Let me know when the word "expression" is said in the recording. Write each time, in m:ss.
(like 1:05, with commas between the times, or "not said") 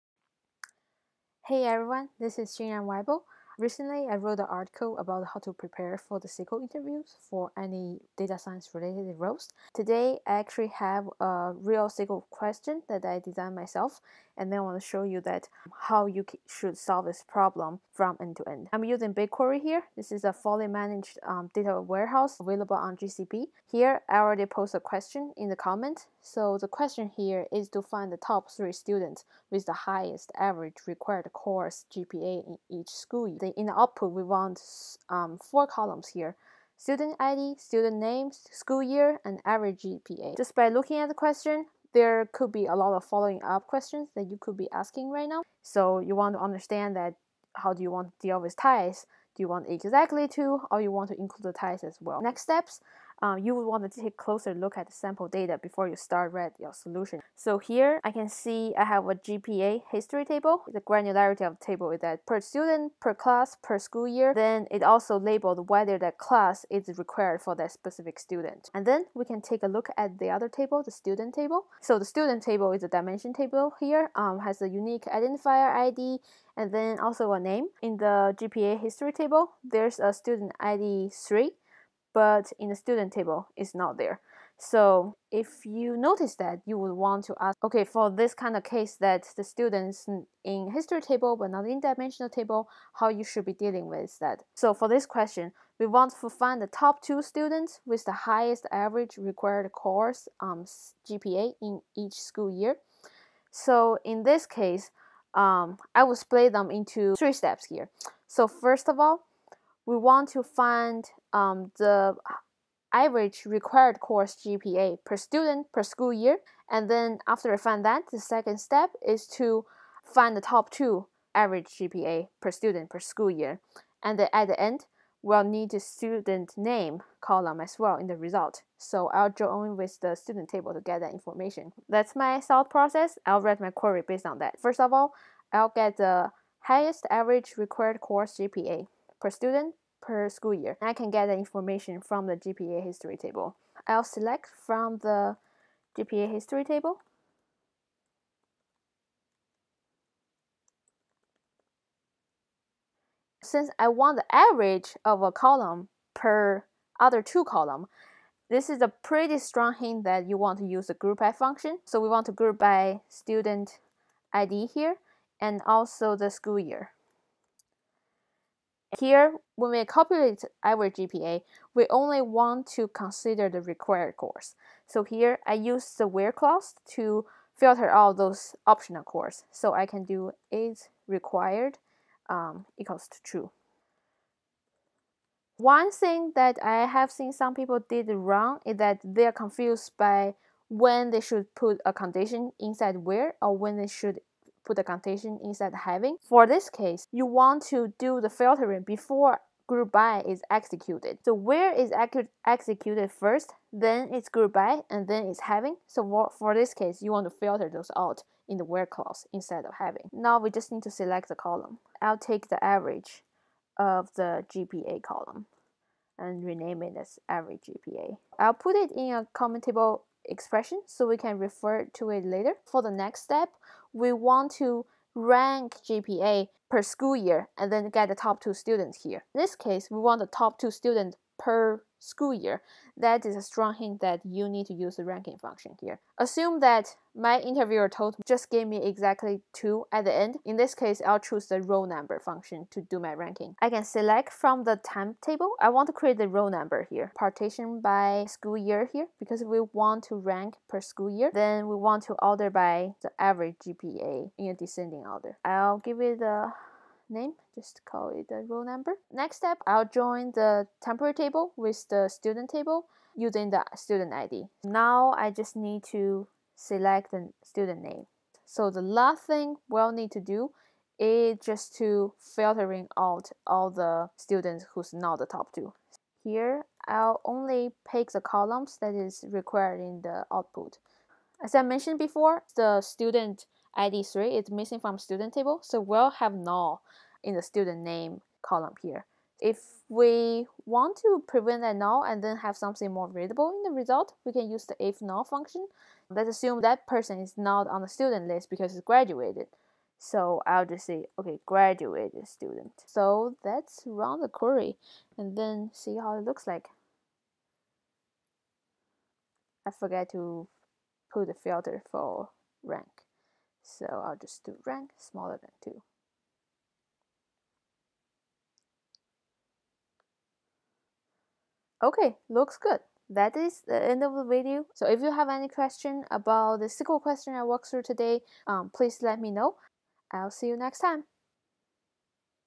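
3:40.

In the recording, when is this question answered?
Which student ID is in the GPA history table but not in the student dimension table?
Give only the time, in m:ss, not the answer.
1:20.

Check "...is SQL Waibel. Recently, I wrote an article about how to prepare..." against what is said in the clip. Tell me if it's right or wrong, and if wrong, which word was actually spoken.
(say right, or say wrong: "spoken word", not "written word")
wrong: "Xinran", not "SQL".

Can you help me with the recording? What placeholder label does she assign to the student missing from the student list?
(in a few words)
graduated student.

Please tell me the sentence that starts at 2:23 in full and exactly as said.
I'll select from the GPA history table.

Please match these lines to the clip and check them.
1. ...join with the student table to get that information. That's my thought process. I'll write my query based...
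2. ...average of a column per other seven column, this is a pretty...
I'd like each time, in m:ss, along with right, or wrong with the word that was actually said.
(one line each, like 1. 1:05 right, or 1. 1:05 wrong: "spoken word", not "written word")
1. 2:09 right
2. 2:34 wrong: "two", not "seven".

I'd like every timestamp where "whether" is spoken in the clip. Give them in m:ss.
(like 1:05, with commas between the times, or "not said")
1:05.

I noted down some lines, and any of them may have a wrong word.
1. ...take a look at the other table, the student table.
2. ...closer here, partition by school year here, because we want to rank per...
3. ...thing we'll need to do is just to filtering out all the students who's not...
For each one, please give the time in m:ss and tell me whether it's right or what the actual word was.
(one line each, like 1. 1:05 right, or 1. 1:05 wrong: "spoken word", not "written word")
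1. 1:09 right
2. 4:06 wrong: "number", not "closer"
3. 4:29 right.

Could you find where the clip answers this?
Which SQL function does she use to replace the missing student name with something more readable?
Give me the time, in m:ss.
4:54.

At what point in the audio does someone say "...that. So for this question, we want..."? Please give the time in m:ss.
1:34.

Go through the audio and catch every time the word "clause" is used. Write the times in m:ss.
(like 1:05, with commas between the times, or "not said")
2:56, 3:28.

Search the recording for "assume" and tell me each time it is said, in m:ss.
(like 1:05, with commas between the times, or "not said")
3:56, 4:56.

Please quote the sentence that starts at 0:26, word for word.
So the question here is to find the top three students with the highest average required course GPA in each school.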